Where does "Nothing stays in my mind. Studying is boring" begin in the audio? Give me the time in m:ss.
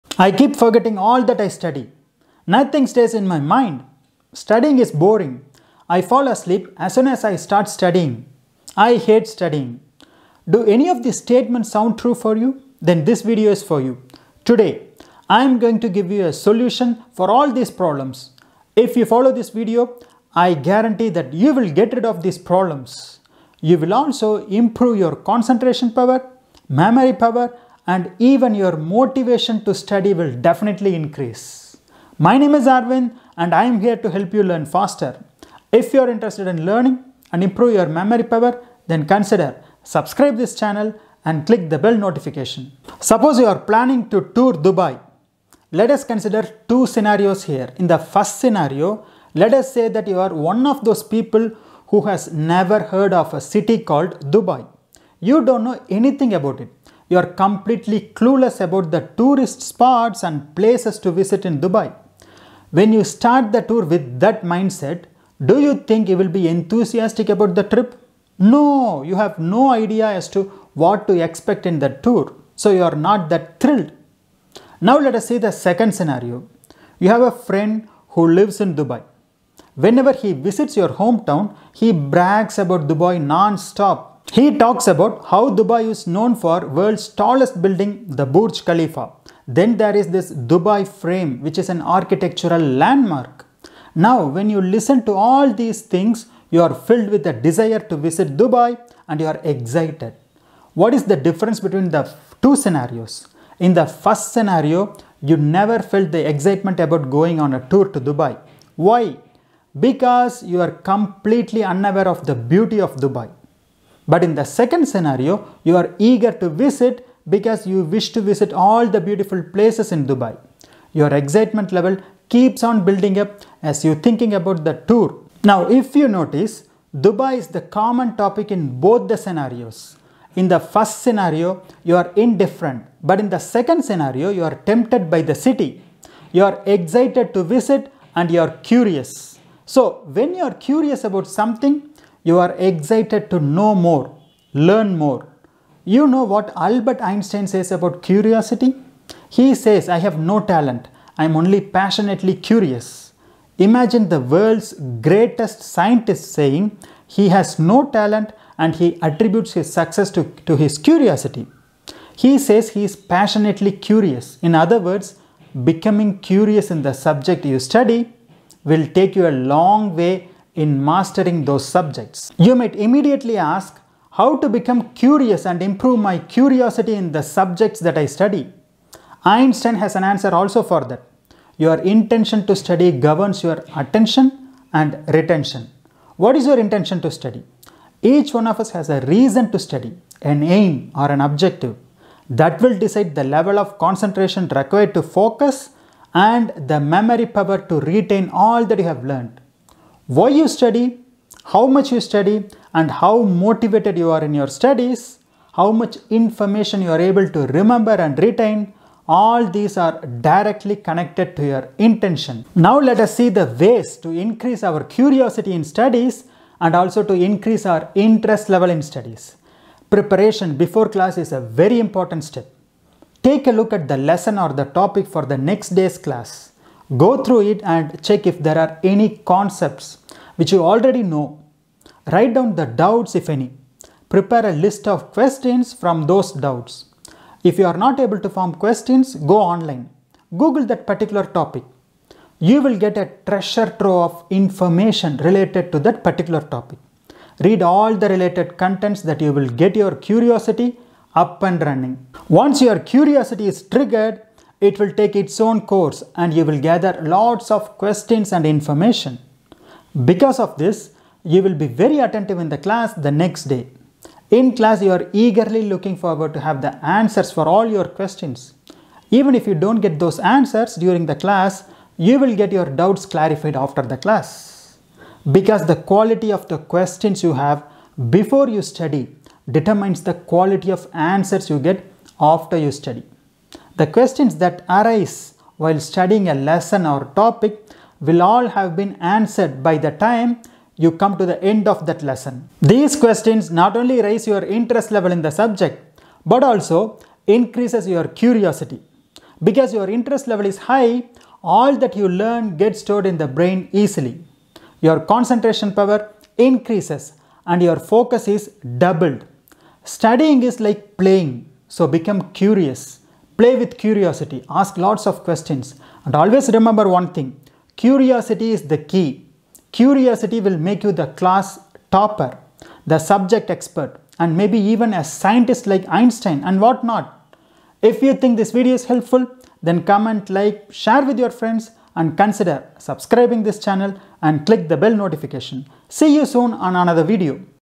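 0:02.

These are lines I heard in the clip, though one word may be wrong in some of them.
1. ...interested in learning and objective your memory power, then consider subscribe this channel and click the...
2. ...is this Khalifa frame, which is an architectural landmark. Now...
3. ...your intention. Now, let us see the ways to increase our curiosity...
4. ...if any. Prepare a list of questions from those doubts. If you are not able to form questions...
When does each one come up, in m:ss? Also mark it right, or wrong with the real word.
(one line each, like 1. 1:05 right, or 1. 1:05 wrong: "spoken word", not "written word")
1. 0:36 wrong: "improve", not "objective"
2. 1:29 wrong: "Dubai", not "Khalifa"
3. 3:31 right
4. 3:53 right.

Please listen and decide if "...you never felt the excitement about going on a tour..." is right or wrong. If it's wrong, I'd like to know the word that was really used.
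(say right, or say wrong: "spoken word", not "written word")
right.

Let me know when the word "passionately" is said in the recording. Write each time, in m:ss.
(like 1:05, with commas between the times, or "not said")
2:31, 2:42.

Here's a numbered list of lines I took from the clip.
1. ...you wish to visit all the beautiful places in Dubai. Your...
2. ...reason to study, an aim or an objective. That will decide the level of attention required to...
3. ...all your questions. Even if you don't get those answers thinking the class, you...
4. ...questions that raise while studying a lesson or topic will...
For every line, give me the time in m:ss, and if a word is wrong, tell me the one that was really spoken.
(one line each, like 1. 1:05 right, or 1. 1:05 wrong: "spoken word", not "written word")
1. 1:57 right
2. 3:09 wrong: "concentration", not "attention"
3. 4:27 wrong: "during", not "thinking"
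4. 4:43 wrong: "arise", not "raise".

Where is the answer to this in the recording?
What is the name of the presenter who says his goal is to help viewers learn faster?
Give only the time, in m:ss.
0:32.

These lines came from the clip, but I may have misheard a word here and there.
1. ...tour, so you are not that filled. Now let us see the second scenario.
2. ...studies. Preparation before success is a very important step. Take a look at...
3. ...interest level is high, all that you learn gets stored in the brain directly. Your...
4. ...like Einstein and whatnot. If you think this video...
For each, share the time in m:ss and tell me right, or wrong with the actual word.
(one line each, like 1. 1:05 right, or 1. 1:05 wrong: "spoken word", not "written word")
1. 1:11 wrong: "thrilled", not "filled"
2. 3:38 wrong: "class", not "success"
3. 4:59 wrong: "easily", not "directly"
4. 5:25 right.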